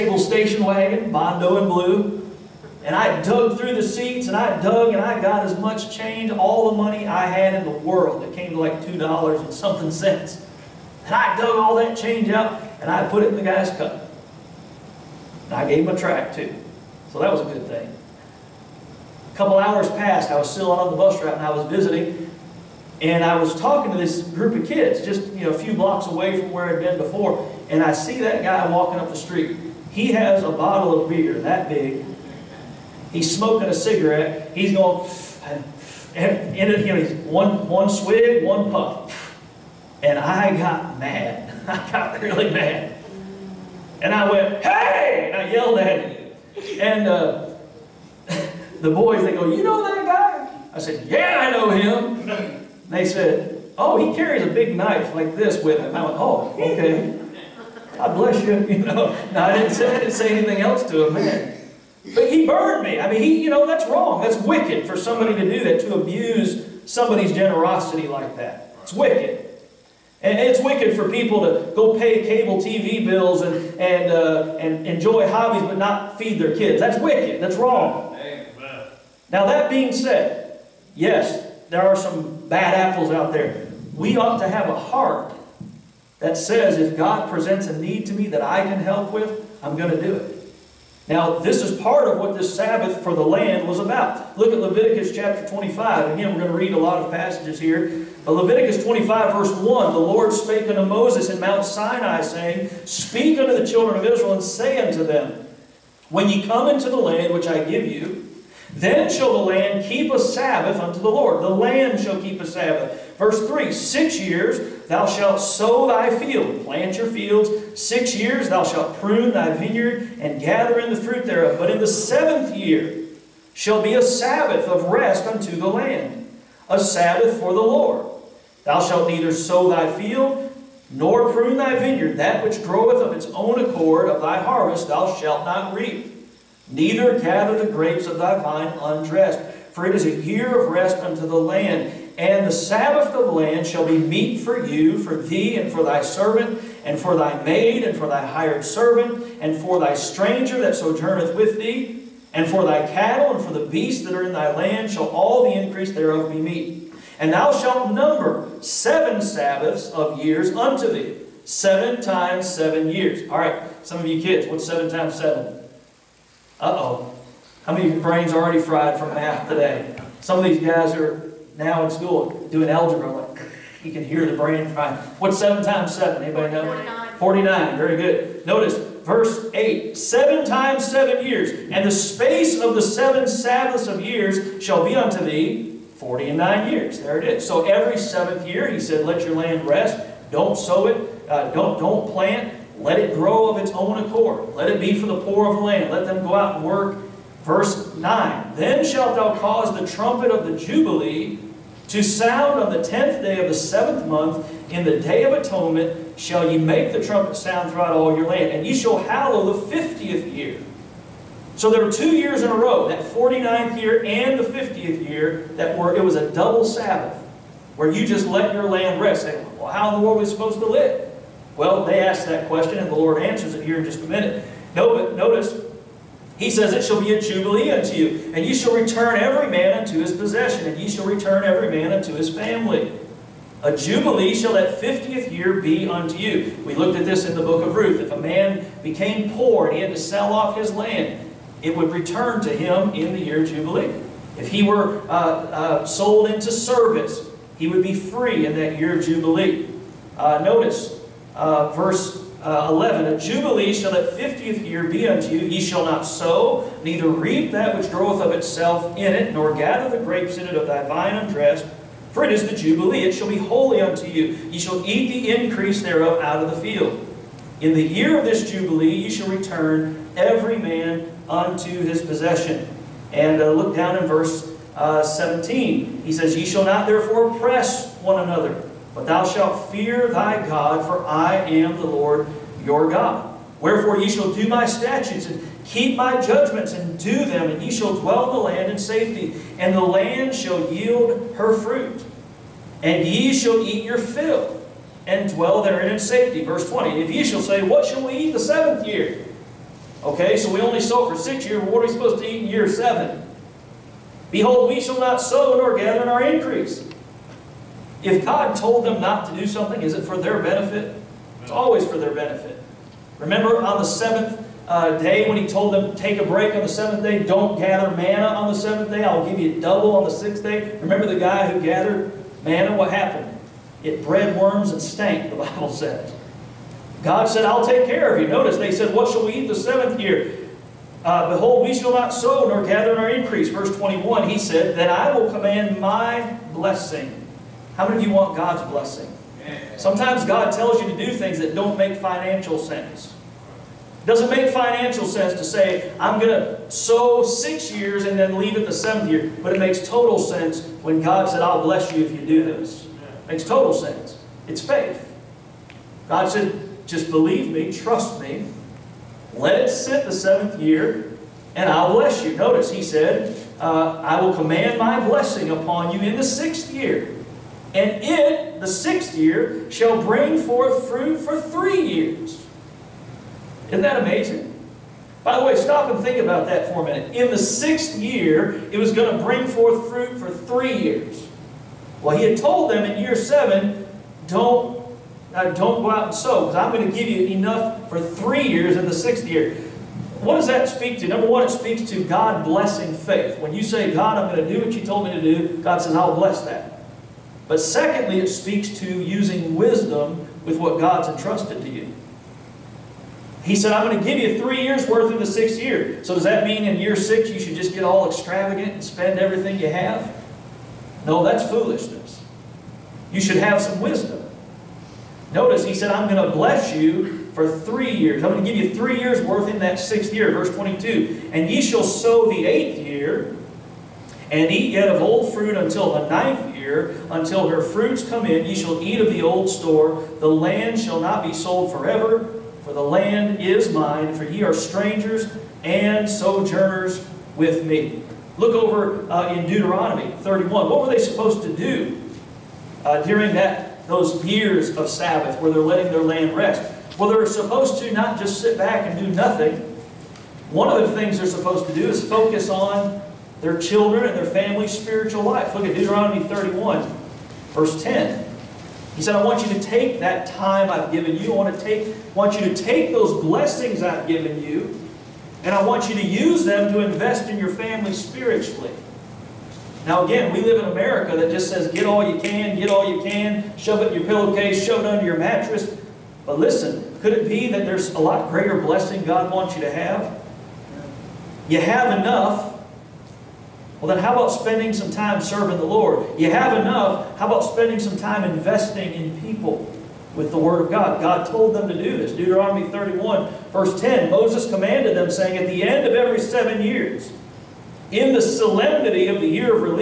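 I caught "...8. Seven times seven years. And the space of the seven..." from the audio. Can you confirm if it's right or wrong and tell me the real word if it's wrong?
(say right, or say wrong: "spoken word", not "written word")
right.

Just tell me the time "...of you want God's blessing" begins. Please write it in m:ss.
5:38.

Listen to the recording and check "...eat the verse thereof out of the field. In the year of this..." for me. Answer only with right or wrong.
wrong.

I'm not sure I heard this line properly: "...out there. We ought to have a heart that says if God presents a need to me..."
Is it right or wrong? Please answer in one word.
right.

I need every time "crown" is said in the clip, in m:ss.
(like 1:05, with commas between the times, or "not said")
not said.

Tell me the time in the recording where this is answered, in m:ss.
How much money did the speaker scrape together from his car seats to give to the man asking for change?
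0:08.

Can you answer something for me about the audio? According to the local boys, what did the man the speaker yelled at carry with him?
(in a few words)
A big knife.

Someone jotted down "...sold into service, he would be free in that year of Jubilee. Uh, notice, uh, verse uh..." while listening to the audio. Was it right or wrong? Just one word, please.
right.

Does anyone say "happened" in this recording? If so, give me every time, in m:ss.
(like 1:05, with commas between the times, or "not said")
5:22.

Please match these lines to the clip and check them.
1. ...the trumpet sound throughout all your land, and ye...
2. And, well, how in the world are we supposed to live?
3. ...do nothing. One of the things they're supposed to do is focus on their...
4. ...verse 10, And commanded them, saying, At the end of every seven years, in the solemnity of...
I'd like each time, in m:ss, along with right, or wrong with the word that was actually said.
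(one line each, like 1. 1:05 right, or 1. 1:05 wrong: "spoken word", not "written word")
1. 3:26 right
2. 3:39 right
3. 7:28 right
4. 8:13 wrong: "Moses", not "And".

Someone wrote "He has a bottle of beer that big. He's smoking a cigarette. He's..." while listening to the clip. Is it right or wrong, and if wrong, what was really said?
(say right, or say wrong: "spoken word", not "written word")
right.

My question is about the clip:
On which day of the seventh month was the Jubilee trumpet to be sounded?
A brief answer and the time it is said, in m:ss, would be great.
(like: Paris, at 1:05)
10th day, at 3:22.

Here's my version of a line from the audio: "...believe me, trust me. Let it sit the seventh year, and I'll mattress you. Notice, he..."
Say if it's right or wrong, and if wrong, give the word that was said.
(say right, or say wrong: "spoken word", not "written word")
wrong: "bless", not "mattress".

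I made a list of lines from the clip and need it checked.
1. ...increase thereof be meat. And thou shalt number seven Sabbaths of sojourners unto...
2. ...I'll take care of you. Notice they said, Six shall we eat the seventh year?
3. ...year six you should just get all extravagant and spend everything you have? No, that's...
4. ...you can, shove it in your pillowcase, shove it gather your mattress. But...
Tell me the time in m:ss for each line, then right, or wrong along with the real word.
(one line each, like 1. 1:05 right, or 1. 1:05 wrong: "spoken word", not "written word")
1. 2:35 wrong: "years", not "sojourners"
2. 5:27 wrong: "What", not "Six"
3. 6:46 right
4. 7:52 wrong: "under", not "gather".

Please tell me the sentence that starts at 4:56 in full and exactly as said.
Verse 20, And if ye shall say, What shall we eat the seventh year?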